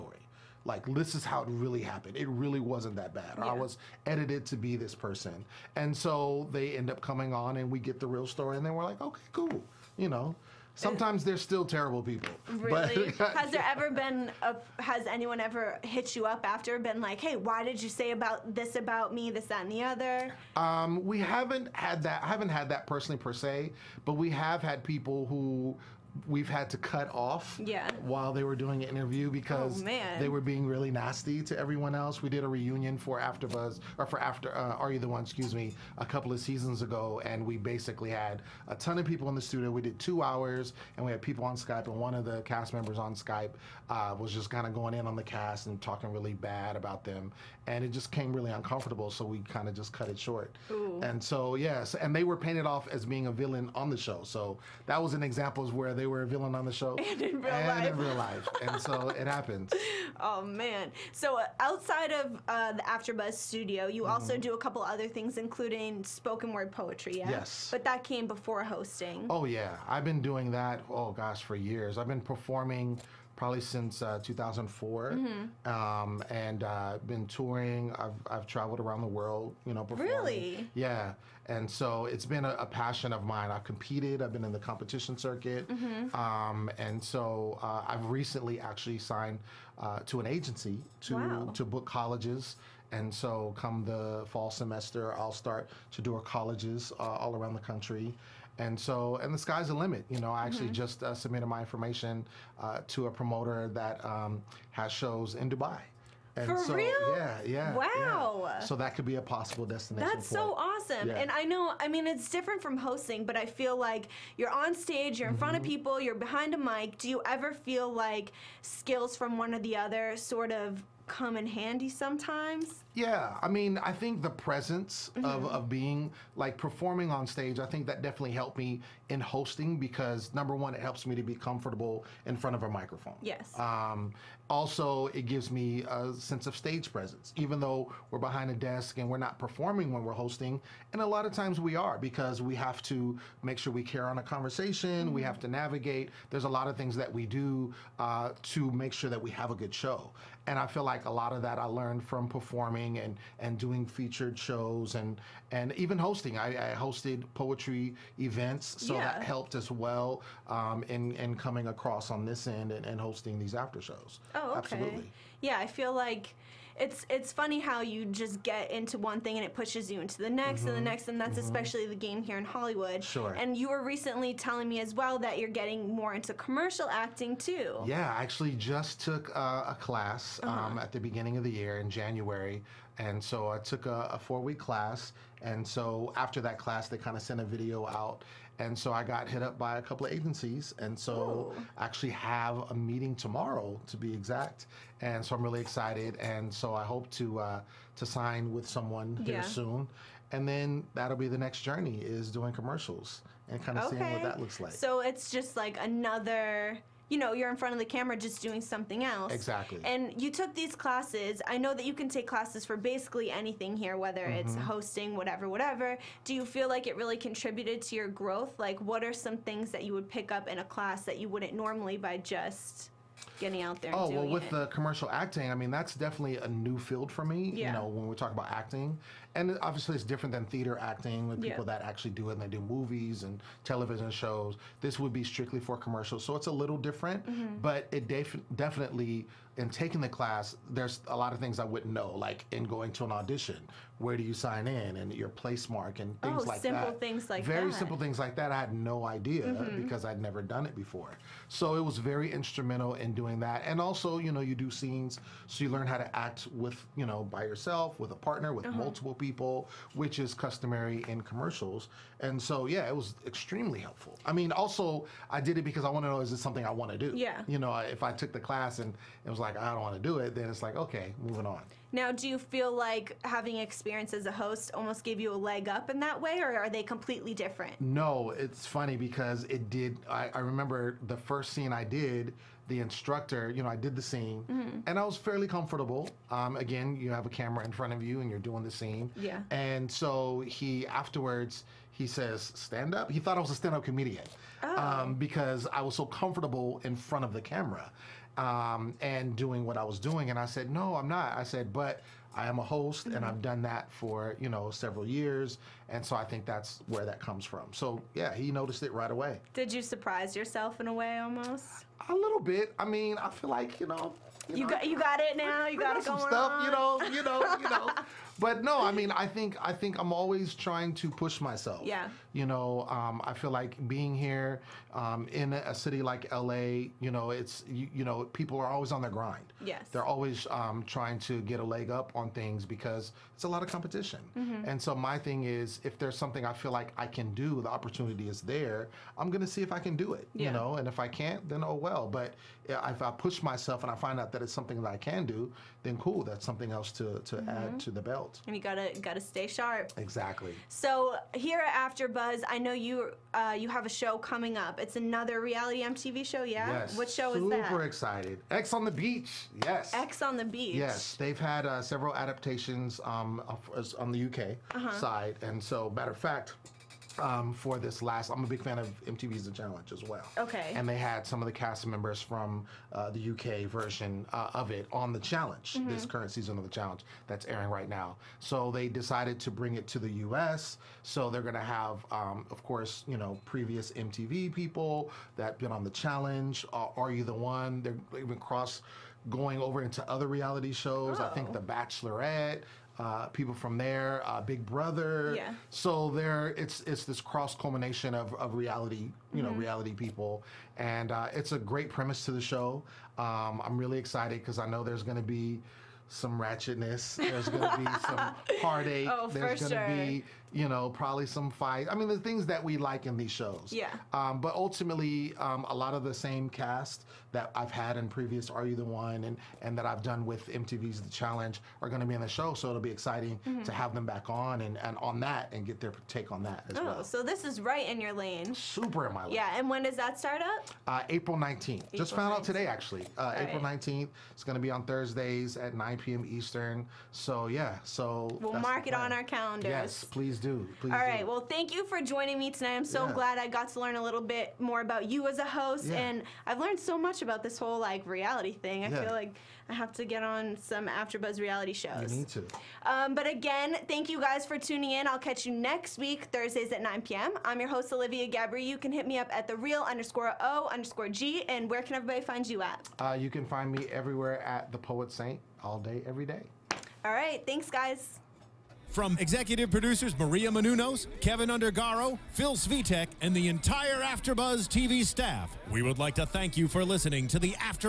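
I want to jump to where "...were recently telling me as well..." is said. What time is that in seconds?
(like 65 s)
173 s.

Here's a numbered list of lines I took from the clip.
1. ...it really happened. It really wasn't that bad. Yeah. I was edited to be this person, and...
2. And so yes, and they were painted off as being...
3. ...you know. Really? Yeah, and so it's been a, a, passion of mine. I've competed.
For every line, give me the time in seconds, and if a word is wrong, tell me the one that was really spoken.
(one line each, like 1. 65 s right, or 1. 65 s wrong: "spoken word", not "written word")
1. 1 s right
2. 51 s right
3. 79 s right.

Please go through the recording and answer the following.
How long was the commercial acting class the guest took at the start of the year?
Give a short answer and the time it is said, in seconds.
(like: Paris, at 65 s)
four week, at 184 s.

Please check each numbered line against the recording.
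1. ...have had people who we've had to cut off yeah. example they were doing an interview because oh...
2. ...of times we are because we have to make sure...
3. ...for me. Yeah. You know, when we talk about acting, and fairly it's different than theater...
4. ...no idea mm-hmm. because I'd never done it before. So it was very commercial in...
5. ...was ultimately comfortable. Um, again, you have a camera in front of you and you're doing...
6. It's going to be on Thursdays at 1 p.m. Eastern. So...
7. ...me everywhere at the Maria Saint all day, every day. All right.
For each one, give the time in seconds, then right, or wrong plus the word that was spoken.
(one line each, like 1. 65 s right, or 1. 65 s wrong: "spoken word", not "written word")
1. 24 s wrong: "while", not "example"
2. 141 s right
3. 227 s wrong: "obviously", not "fairly"
4. 248 s wrong: "instrumental", not "commercial"
5. 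285 s wrong: "fairly", not "ultimately"
6. 434 s wrong: "9", not "1"
7. 463 s wrong: "Poet", not "Maria".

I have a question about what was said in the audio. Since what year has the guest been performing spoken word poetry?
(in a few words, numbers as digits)
2004.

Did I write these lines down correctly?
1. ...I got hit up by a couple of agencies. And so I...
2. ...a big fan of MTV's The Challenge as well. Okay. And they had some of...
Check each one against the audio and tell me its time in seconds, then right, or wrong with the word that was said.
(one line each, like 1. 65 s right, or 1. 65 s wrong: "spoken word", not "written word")
1. 188 s right
2. 368 s right.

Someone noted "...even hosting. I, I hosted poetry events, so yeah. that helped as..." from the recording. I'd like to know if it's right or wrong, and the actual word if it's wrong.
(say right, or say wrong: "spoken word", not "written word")
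right.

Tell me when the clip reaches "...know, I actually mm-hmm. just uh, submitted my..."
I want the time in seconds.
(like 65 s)
100 s.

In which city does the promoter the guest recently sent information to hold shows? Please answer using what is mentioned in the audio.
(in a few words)
Dubai.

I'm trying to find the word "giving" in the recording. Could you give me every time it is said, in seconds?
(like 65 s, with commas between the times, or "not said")
not said.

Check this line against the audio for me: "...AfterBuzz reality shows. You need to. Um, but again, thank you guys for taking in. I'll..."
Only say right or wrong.
wrong.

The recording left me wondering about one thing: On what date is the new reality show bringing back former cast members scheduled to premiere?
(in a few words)
April 19th.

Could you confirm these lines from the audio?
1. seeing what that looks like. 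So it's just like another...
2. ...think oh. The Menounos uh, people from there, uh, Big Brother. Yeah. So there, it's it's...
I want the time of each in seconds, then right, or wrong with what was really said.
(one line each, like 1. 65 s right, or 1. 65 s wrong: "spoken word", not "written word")
1. 203 s right
2. 391 s wrong: "Bachelorette", not "Menounos".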